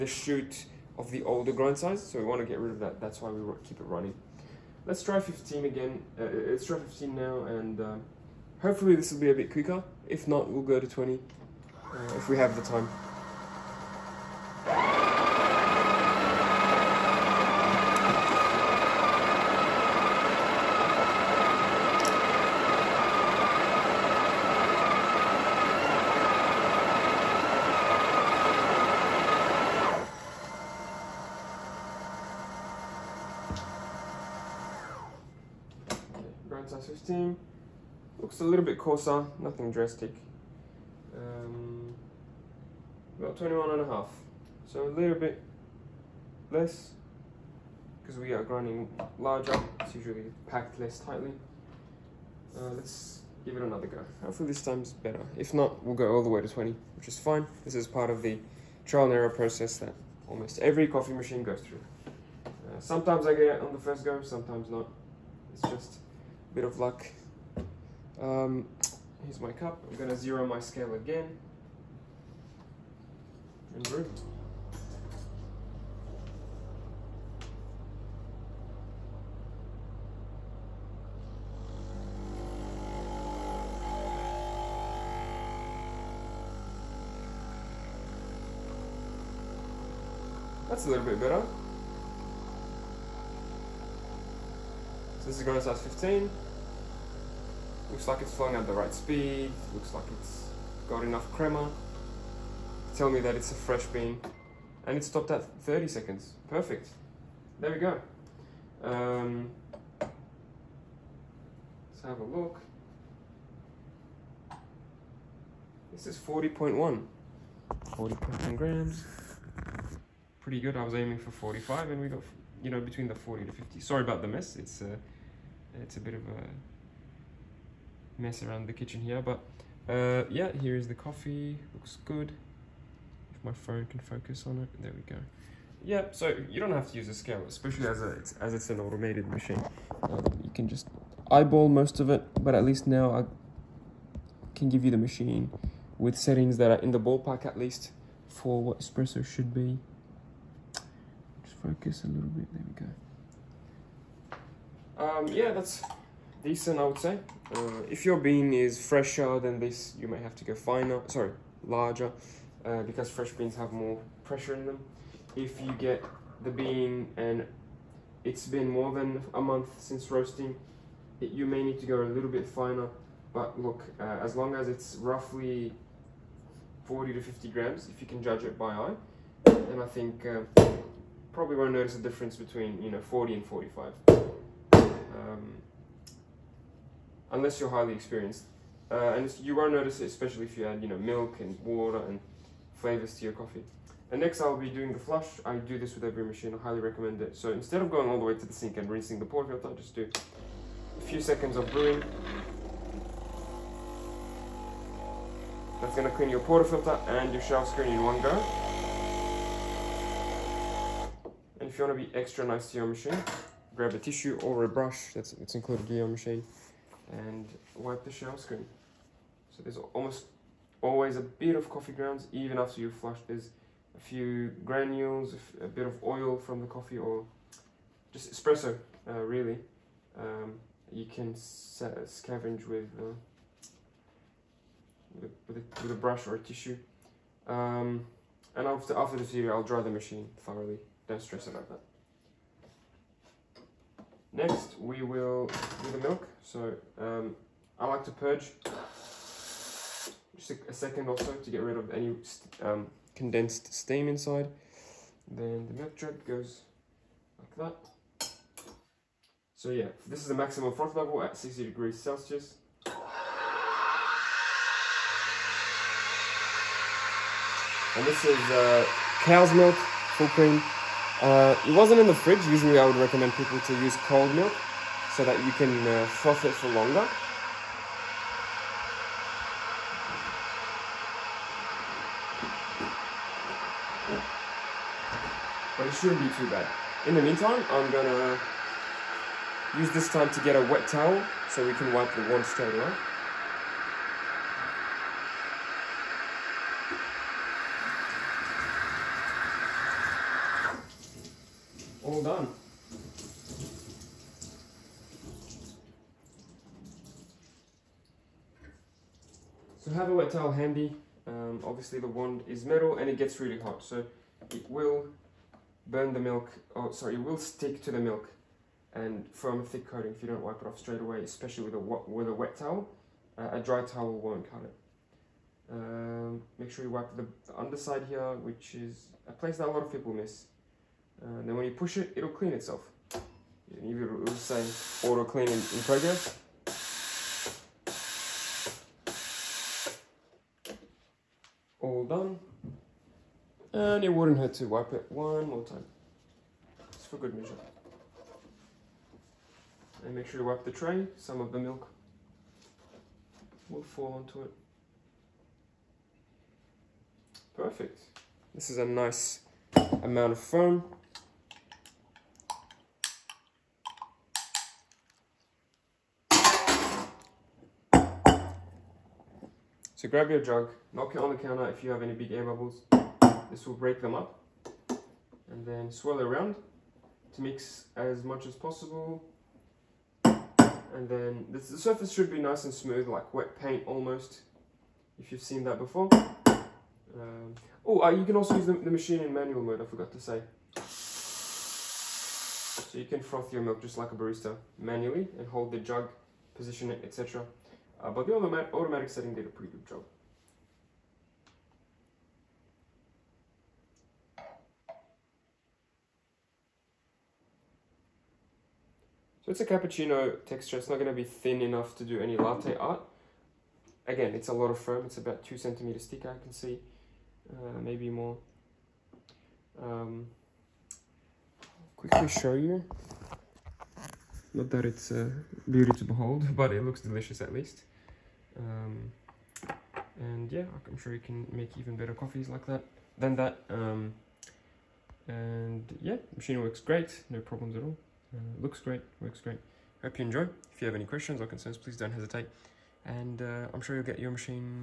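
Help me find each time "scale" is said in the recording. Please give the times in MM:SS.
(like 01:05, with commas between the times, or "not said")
01:10, 02:17.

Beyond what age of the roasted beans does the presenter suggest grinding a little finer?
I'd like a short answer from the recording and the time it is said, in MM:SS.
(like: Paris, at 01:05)
a month, at 02:48.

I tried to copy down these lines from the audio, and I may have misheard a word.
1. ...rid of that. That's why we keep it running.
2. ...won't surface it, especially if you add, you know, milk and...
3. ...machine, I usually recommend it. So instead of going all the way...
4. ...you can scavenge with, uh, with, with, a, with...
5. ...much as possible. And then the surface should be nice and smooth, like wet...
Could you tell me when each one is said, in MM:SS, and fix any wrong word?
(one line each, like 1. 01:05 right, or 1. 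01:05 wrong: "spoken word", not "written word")
1. 00:02 right
2. 03:09 wrong: "notice", not "surface"
3. 03:16 wrong: "highly", not "usually"
4. 03:50 right
5. 06:18 right.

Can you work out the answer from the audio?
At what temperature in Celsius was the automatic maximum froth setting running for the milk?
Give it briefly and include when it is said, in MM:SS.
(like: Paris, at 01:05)
60 degrees Celsius, at 04:21.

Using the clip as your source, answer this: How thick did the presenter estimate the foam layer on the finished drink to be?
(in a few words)
2 centimeters.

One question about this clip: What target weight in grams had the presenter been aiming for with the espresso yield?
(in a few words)
45.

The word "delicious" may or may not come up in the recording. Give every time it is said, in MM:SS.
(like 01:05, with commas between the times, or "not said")
07:07.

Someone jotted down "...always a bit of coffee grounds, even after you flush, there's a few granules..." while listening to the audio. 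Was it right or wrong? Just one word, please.
right.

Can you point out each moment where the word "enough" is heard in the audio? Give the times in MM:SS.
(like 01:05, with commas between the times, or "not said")
01:41, 06:51.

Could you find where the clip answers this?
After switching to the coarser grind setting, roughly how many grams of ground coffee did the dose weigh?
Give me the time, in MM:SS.
00:43.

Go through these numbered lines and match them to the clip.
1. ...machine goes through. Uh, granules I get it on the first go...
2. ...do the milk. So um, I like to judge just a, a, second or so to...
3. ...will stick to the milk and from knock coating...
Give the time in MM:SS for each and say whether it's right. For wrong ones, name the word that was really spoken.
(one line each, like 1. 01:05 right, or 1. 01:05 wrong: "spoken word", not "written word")
1. 01:01 wrong: "sometimes", not "granules"
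2. 04:05 wrong: "purge", not "judge"
3. 05:17 wrong: "thick", not "knock".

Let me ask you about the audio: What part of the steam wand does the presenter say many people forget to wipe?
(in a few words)
the underside.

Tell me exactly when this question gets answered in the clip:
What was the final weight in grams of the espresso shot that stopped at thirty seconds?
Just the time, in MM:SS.
01:57.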